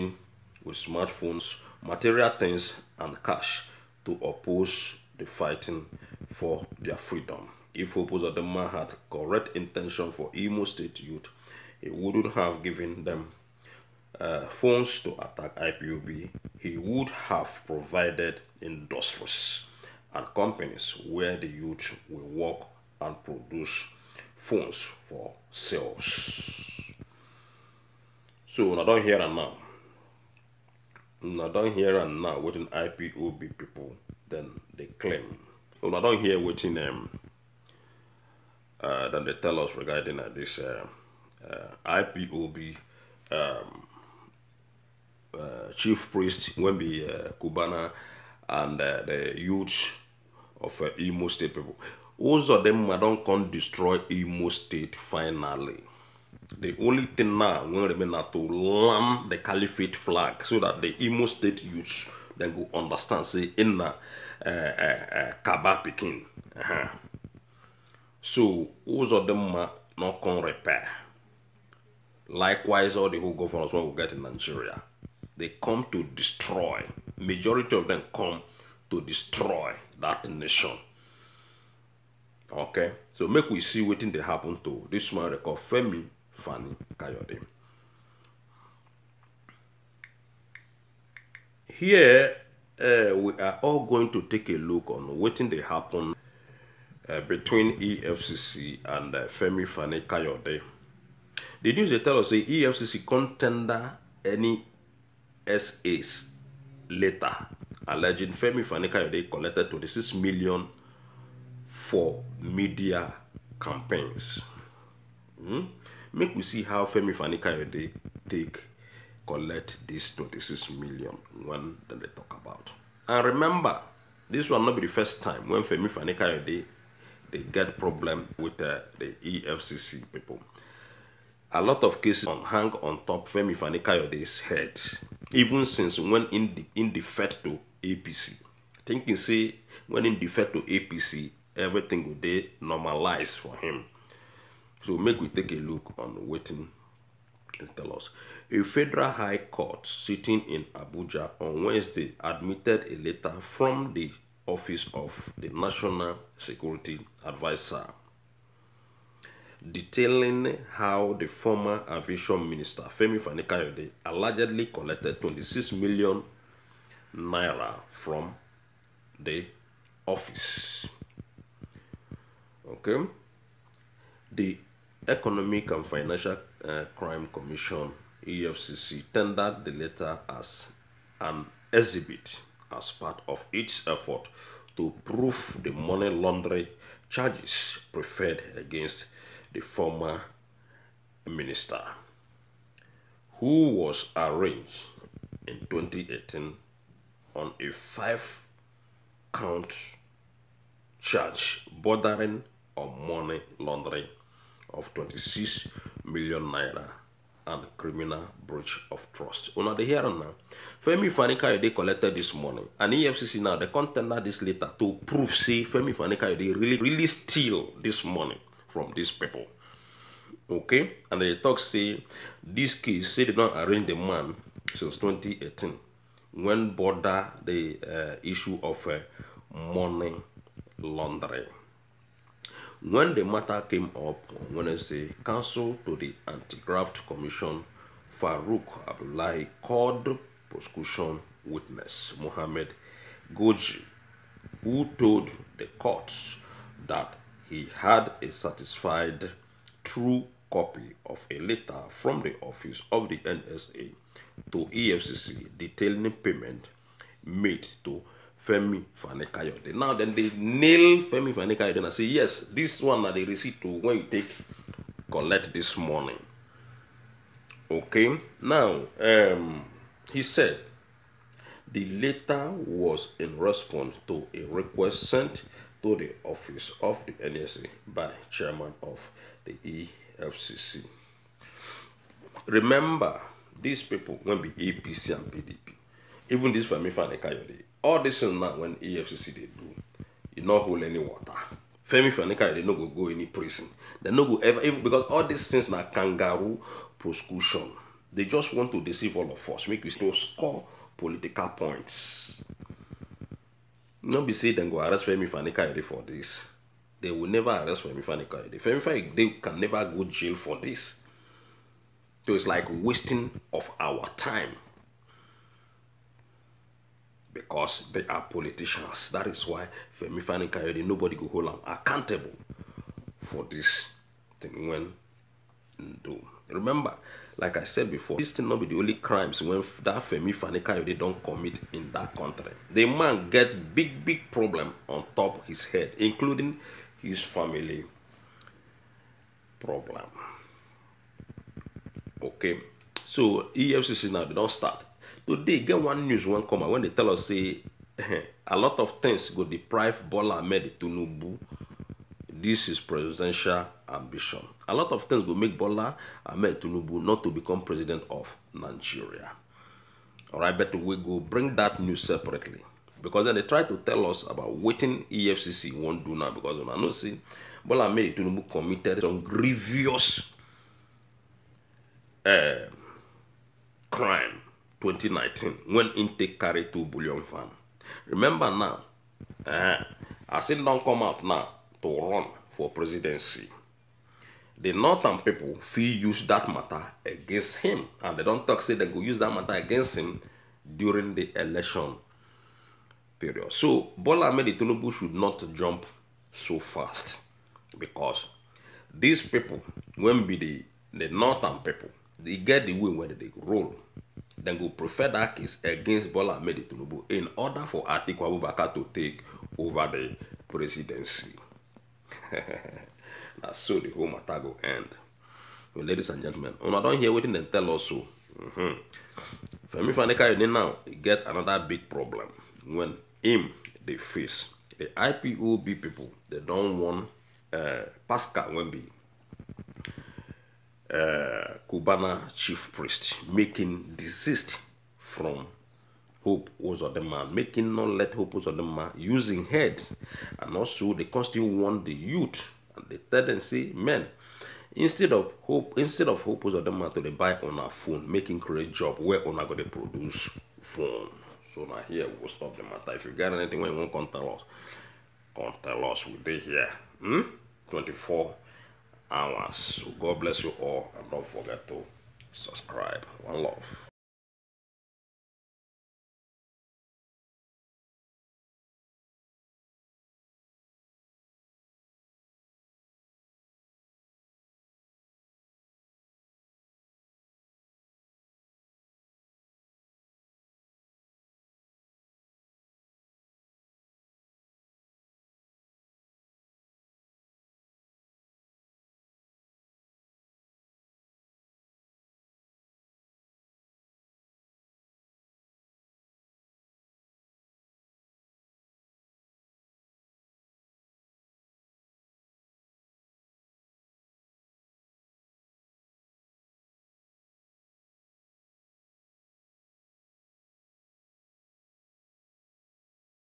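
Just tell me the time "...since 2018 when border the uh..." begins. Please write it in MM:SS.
03:44.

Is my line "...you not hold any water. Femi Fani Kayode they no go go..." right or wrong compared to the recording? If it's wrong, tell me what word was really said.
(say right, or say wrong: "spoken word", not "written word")
right.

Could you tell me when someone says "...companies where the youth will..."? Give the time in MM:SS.
00:20.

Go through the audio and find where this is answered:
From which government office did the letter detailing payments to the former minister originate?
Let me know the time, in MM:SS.
02:35.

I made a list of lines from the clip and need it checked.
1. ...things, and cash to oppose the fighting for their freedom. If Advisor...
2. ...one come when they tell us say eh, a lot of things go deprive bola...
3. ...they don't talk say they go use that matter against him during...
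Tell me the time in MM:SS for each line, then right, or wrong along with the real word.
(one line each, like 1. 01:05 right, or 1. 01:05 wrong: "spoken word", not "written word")
1. 00:02 wrong: "Opozadema", not "Advisor"
2. 05:46 right
3. 06:28 right.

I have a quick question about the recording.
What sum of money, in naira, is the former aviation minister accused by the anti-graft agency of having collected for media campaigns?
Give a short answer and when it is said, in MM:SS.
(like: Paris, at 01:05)
26 million, at 01:49.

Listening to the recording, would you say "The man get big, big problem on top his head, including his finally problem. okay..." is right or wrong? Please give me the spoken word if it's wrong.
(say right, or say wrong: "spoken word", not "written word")
wrong: "family", not "finally".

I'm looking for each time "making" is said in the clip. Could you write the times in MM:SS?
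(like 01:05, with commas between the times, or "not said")
07:13, 07:17, 07:28.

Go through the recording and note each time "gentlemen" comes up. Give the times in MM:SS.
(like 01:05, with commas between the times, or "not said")
06:56.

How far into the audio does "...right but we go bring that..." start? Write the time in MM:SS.
06:00.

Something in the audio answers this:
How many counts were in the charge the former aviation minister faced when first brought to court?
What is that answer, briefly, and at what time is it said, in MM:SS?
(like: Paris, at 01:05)
5, at 03:17.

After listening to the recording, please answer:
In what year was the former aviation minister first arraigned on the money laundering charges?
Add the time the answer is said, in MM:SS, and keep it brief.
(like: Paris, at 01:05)
2018, at 03:14.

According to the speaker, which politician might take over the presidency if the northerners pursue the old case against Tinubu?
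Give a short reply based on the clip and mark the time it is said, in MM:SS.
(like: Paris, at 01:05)
Atiku Abubakar, at 06:47.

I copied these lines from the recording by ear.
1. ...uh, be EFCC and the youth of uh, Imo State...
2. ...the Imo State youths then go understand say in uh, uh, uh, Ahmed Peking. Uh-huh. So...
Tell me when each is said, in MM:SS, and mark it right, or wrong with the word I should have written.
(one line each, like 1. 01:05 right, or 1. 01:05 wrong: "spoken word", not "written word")
1. 00:46 wrong: "Cubana", not "EFCC"
2. 01:00 wrong: "Kaba", not "Ahmed".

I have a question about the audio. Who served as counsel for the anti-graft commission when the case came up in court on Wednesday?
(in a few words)
Farouk Abdullahi.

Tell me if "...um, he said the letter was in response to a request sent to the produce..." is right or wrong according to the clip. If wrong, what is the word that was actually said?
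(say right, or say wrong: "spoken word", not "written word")
wrong: "office", not "produce".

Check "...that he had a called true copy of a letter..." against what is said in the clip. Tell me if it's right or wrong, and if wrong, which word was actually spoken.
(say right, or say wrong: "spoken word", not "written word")
wrong: "certified", not "called".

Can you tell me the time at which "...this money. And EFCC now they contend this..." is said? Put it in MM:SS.
03:32.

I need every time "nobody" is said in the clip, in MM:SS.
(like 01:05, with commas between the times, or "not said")
05:04, 05:20.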